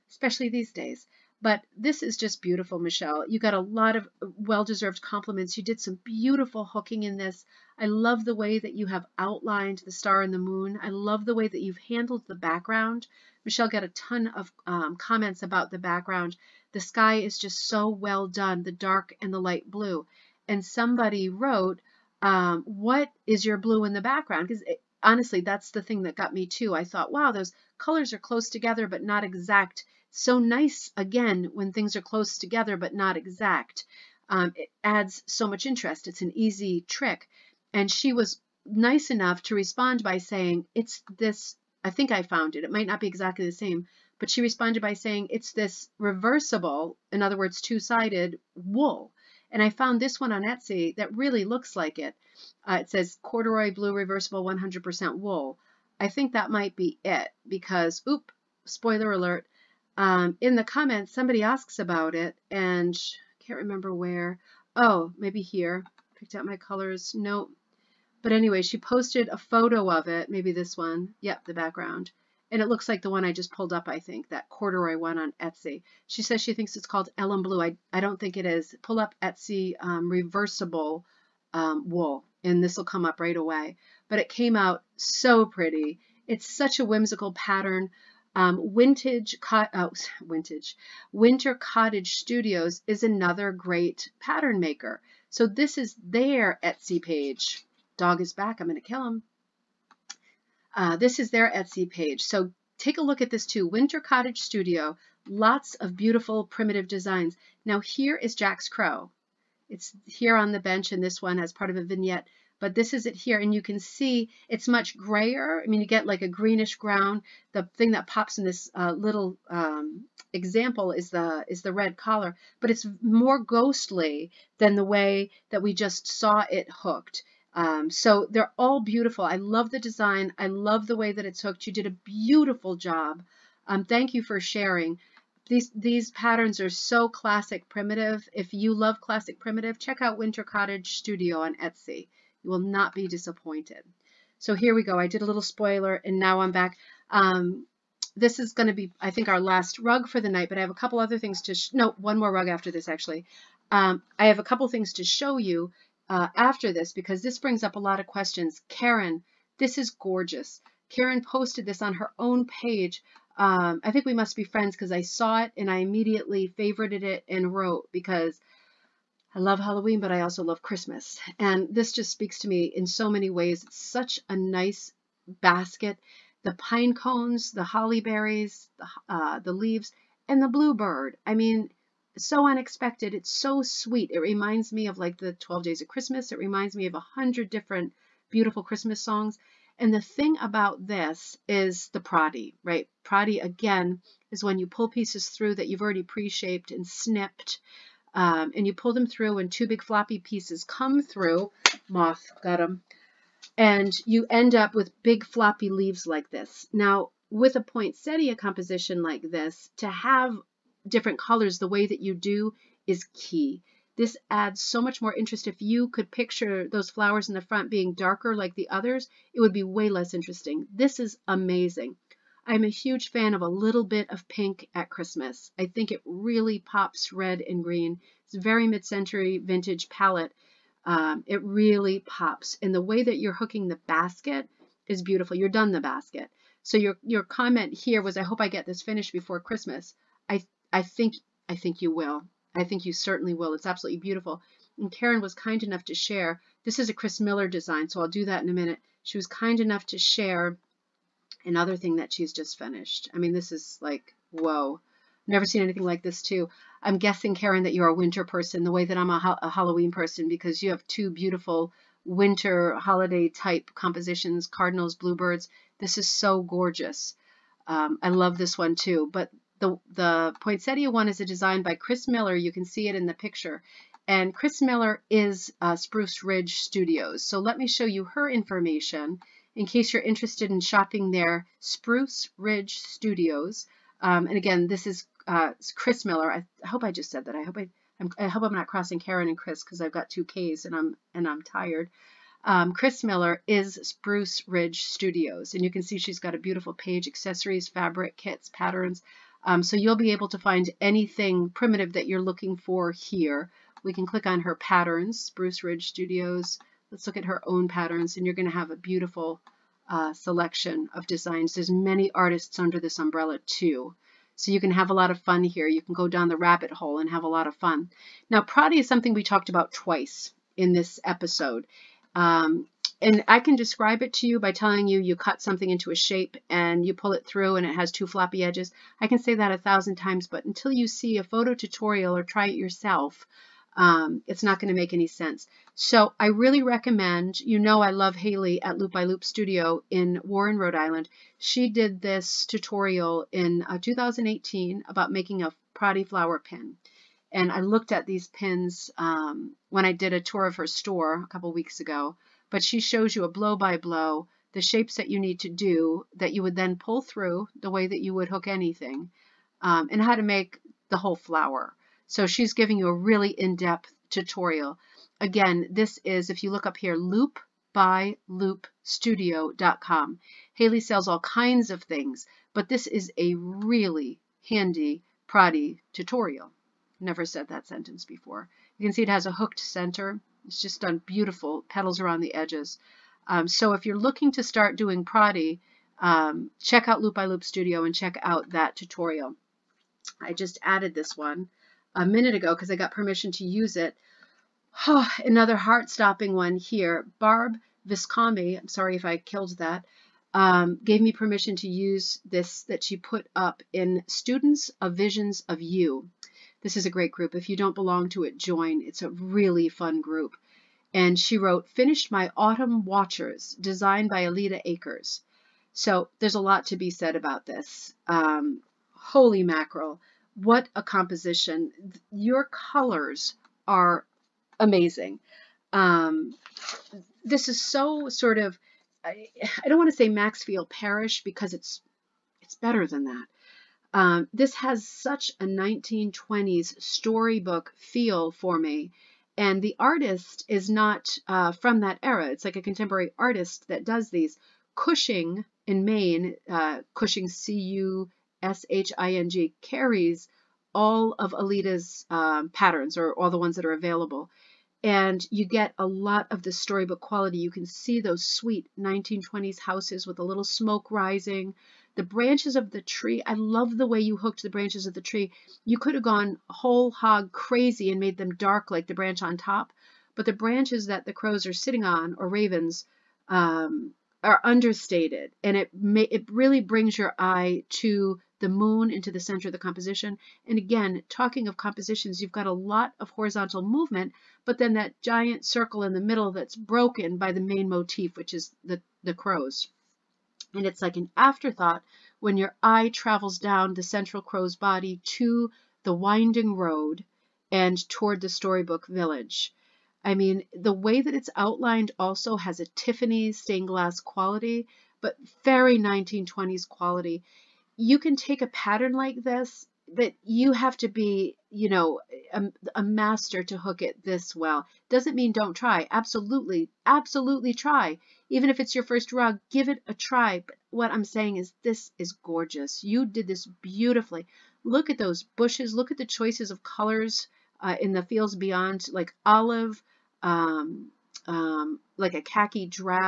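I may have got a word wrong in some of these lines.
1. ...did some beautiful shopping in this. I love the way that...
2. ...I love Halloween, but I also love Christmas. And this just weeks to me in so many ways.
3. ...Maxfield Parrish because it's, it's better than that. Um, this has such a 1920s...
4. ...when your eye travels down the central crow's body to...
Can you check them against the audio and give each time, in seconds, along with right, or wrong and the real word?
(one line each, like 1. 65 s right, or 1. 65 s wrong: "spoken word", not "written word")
1. 5 s wrong: "hooking", not "shopping"
2. 169 s wrong: "speaks", not "weeks"
3. 430 s right
4. 492 s right.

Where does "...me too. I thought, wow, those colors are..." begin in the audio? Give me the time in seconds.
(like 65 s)
26 s.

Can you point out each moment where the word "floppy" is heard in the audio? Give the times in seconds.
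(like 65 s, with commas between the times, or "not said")
199 s, 205 s, 328 s.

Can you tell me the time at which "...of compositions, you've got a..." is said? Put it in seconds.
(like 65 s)
481 s.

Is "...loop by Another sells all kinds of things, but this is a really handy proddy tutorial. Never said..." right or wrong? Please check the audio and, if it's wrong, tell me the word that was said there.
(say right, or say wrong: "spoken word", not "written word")
wrong: "Haley", not "Another".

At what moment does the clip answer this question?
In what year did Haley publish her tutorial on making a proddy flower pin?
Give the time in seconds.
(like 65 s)
343 s.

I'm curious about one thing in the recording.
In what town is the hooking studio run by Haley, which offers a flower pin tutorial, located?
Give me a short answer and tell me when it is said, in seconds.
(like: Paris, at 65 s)
Warren, Rhode Island, at 340 s.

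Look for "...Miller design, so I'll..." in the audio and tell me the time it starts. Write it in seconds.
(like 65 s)
247 s.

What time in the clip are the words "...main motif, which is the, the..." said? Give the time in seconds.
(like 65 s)
487 s.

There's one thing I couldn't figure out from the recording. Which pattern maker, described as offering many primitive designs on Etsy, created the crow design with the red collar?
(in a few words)
Winter Cottage Studios.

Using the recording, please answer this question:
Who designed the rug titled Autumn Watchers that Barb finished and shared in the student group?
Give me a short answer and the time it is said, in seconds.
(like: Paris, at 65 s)
Alida Akers, at 414 s.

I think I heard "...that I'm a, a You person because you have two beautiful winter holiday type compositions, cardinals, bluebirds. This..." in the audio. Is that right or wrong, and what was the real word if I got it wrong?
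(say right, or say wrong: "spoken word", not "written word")
wrong: "Halloween", not "You".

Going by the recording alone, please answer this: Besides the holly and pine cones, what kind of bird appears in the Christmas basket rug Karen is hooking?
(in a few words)
bluebird.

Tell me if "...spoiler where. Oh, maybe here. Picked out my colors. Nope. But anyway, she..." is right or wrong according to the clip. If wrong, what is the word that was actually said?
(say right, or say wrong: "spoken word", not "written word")
wrong: "remember", not "spoiler".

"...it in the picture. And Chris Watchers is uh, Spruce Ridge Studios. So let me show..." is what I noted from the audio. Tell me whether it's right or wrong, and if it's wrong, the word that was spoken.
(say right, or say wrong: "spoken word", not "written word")
wrong: "Miller", not "Watchers".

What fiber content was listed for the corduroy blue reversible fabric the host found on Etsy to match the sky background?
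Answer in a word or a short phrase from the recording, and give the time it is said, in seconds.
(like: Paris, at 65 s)
100% wool, at 54 s.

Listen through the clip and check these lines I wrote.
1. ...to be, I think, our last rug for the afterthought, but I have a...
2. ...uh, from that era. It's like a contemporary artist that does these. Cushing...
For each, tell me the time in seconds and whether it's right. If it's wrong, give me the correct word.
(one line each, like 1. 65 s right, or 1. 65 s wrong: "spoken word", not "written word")
1. 148 s wrong: "night", not "afterthought"
2. 441 s right.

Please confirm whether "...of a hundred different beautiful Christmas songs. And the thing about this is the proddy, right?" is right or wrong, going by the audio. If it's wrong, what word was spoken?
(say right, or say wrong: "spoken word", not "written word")
right.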